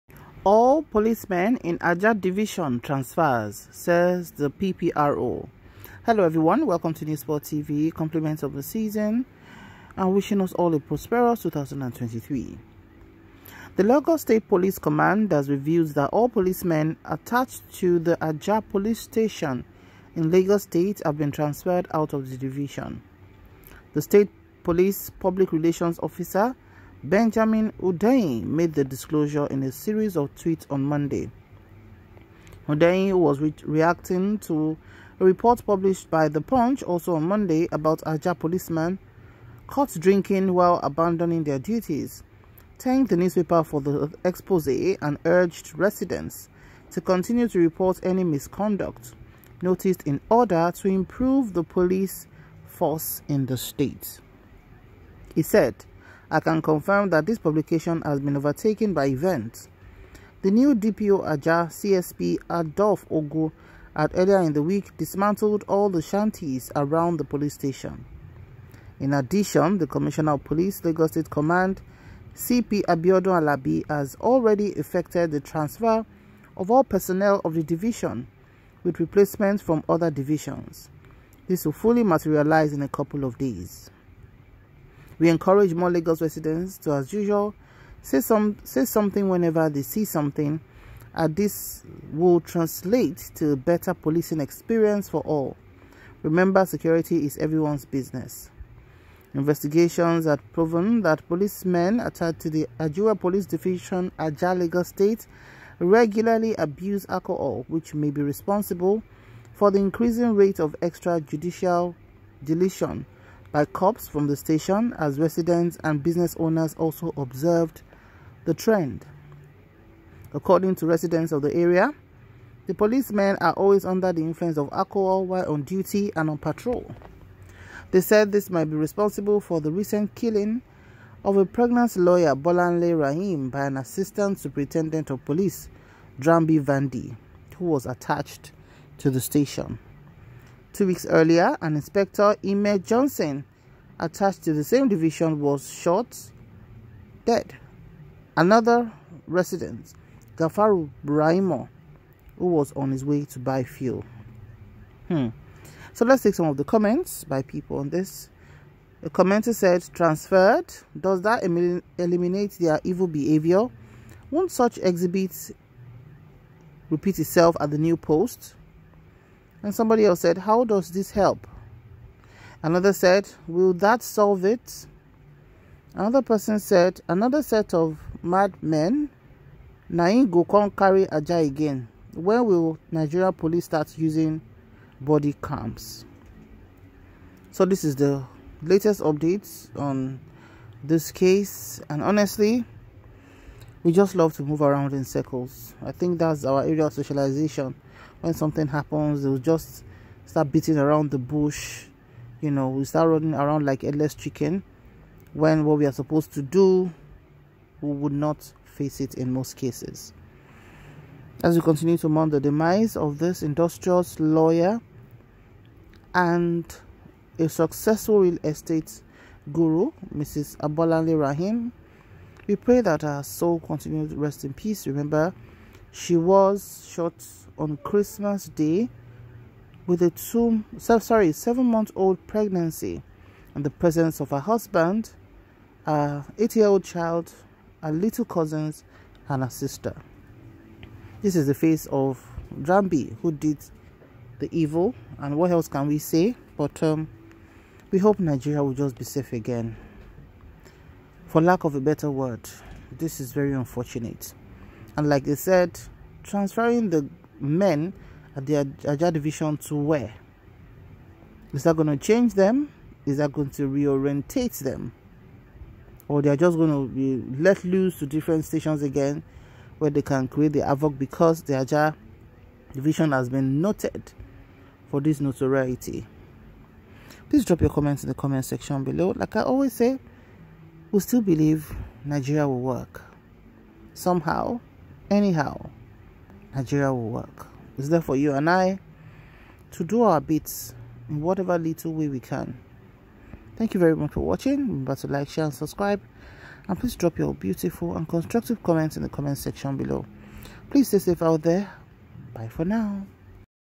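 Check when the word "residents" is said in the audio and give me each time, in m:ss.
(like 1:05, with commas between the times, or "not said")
0:45, 1:26, 1:55, 2:00, 2:29.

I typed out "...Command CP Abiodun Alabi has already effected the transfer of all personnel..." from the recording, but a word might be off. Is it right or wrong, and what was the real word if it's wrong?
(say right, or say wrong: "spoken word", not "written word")
right.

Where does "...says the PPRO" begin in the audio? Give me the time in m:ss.
0:03.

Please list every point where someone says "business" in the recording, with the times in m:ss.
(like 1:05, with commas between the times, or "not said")
1:37, 1:56.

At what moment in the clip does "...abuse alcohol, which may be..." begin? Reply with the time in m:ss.
1:46.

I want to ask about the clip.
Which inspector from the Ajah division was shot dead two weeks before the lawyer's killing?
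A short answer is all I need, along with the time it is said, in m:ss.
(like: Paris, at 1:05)
Ime Johnson, at 2:22.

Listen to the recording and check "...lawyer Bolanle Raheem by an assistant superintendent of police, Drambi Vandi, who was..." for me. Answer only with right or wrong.
right.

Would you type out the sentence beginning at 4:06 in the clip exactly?
But um, we hope Nigeria will just be safe again.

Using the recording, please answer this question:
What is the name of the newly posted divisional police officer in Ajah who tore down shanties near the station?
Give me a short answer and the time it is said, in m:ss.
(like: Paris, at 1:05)
Adolf Ogo, at 1:02.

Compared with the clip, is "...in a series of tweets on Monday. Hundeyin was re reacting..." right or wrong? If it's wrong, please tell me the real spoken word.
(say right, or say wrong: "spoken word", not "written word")
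right.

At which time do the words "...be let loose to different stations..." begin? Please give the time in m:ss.
4:26.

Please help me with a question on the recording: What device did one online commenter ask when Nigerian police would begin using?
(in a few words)
body cams.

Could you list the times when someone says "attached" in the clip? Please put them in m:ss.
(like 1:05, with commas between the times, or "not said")
0:17, 1:41, 2:17, 2:23.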